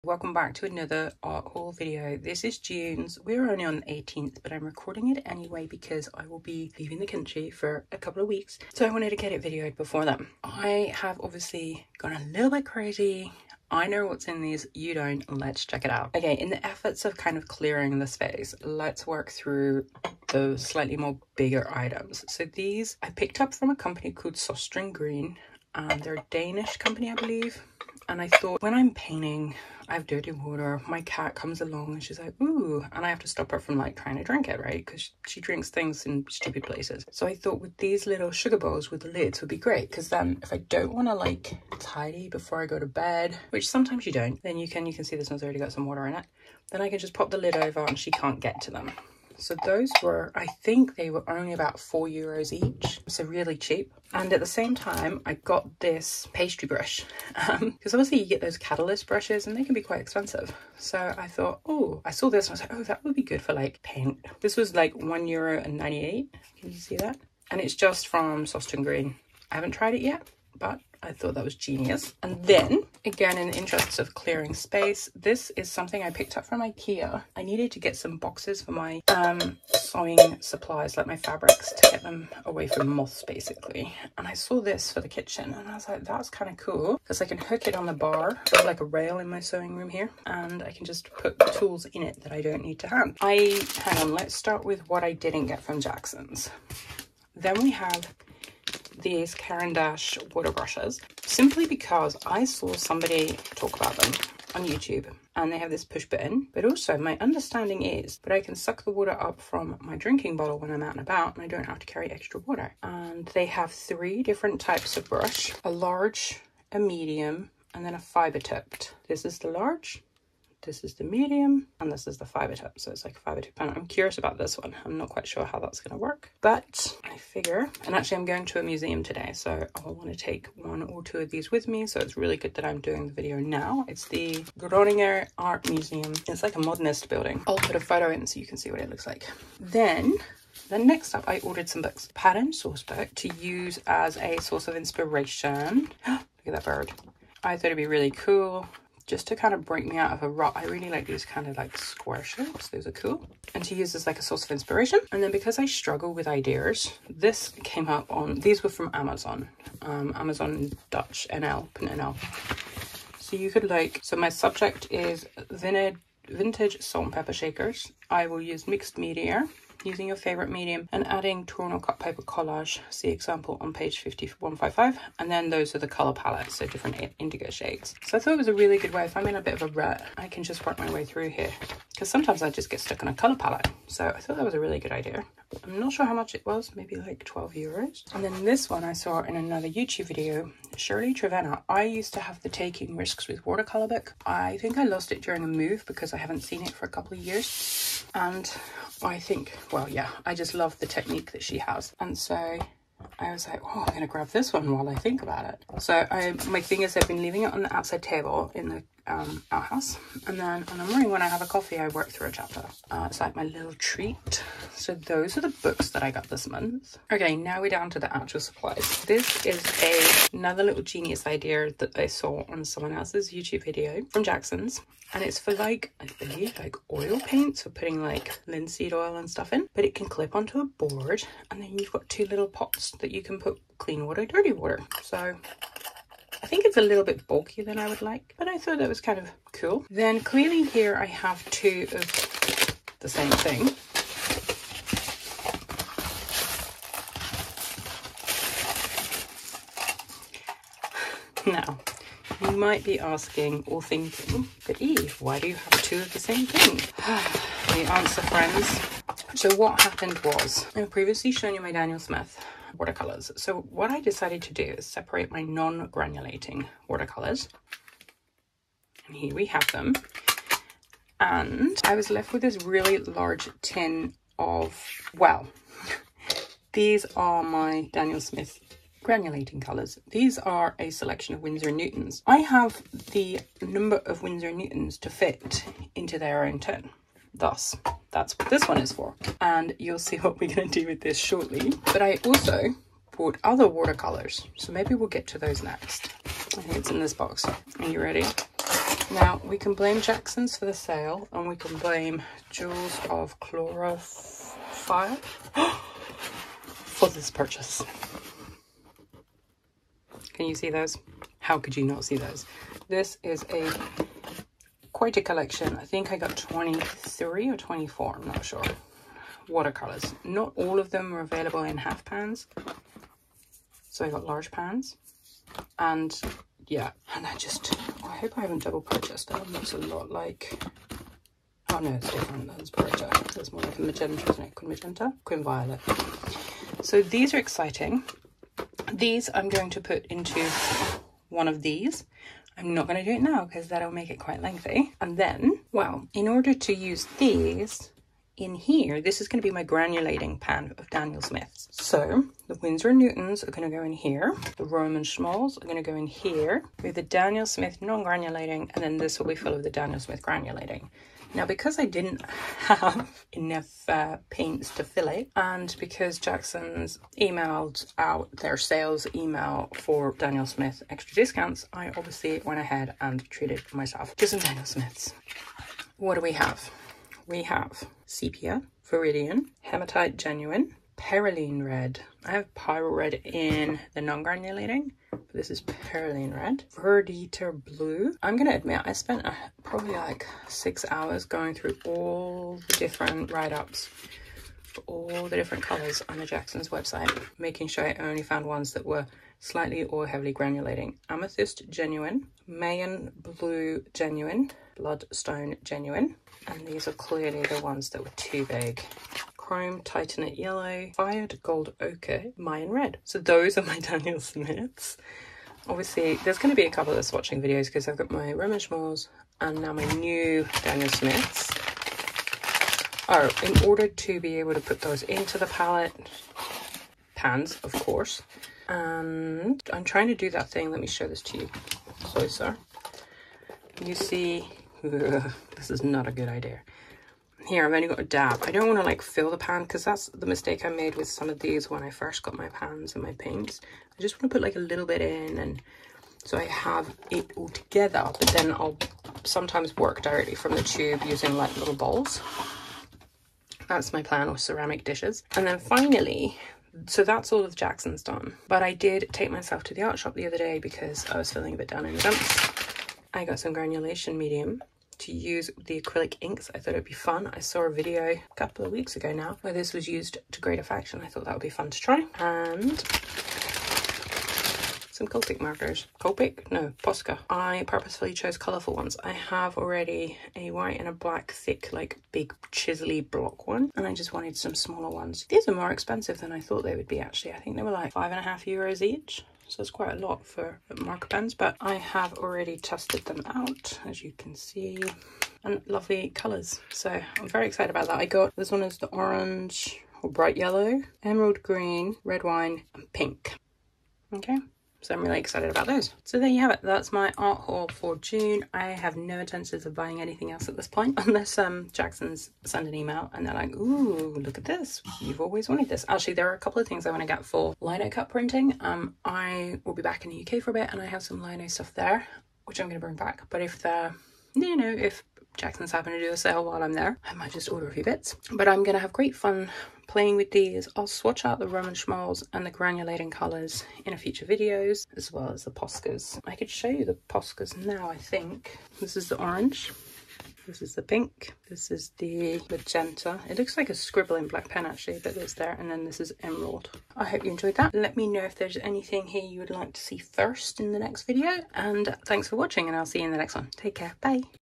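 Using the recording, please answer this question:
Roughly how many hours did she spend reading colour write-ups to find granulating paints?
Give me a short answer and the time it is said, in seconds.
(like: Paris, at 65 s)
6, at 390 s.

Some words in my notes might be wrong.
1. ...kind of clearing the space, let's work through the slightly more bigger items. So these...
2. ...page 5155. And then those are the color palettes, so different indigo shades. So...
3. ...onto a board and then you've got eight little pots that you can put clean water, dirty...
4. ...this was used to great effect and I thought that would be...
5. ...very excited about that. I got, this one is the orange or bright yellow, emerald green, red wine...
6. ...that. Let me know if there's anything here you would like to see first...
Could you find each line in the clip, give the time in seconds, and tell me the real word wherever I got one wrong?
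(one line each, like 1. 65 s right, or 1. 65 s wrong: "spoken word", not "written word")
1. 17 s right
2. 173 s right
3. 230 s wrong: "two", not "eight"
4. 469 s right
5. 497 s right
6. 547 s right.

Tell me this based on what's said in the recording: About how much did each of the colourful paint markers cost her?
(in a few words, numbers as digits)
5.50 euros.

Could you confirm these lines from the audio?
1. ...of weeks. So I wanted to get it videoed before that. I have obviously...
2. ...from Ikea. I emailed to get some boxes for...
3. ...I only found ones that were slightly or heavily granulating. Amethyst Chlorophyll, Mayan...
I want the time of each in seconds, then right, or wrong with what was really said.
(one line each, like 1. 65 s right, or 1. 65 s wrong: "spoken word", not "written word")
1. 8 s right
2. 76 s wrong: "needed", not "emailed"
3. 397 s wrong: "Genuine", not "Chlorophyll".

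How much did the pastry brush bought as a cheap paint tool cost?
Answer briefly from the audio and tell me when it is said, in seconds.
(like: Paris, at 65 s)
1.98 euros, at 64 s.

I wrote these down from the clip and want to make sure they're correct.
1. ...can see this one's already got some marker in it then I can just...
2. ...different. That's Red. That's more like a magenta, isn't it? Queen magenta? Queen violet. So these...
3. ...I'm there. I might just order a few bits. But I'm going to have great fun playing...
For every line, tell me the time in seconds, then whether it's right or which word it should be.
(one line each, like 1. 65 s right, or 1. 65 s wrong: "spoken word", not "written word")
1. 44 s wrong: "water", not "marker"
2. 332 s wrong: "Beretta", not "Red"
3. 526 s right.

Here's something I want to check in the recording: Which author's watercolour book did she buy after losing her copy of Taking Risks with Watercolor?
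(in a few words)
Shirley Trevena.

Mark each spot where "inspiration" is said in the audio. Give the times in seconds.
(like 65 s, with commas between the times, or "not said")
144 s, 154 s.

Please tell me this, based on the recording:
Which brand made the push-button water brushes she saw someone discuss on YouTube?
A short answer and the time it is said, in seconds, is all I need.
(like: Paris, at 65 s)
Caran d'Ache, at 99 s.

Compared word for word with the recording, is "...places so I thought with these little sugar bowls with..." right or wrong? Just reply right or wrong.
right.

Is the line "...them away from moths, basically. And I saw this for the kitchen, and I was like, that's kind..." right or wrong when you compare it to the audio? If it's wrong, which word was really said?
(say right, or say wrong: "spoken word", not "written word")
right.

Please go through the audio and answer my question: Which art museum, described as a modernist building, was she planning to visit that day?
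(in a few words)
Groninger Art Museum.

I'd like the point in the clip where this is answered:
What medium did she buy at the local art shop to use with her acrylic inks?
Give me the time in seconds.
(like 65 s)
463 s.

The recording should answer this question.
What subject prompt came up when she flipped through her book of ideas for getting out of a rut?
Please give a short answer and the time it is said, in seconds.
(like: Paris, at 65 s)
vintage salt and pepper shakers, at 166 s.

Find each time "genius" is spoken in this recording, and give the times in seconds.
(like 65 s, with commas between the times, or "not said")
71 s, 220 s.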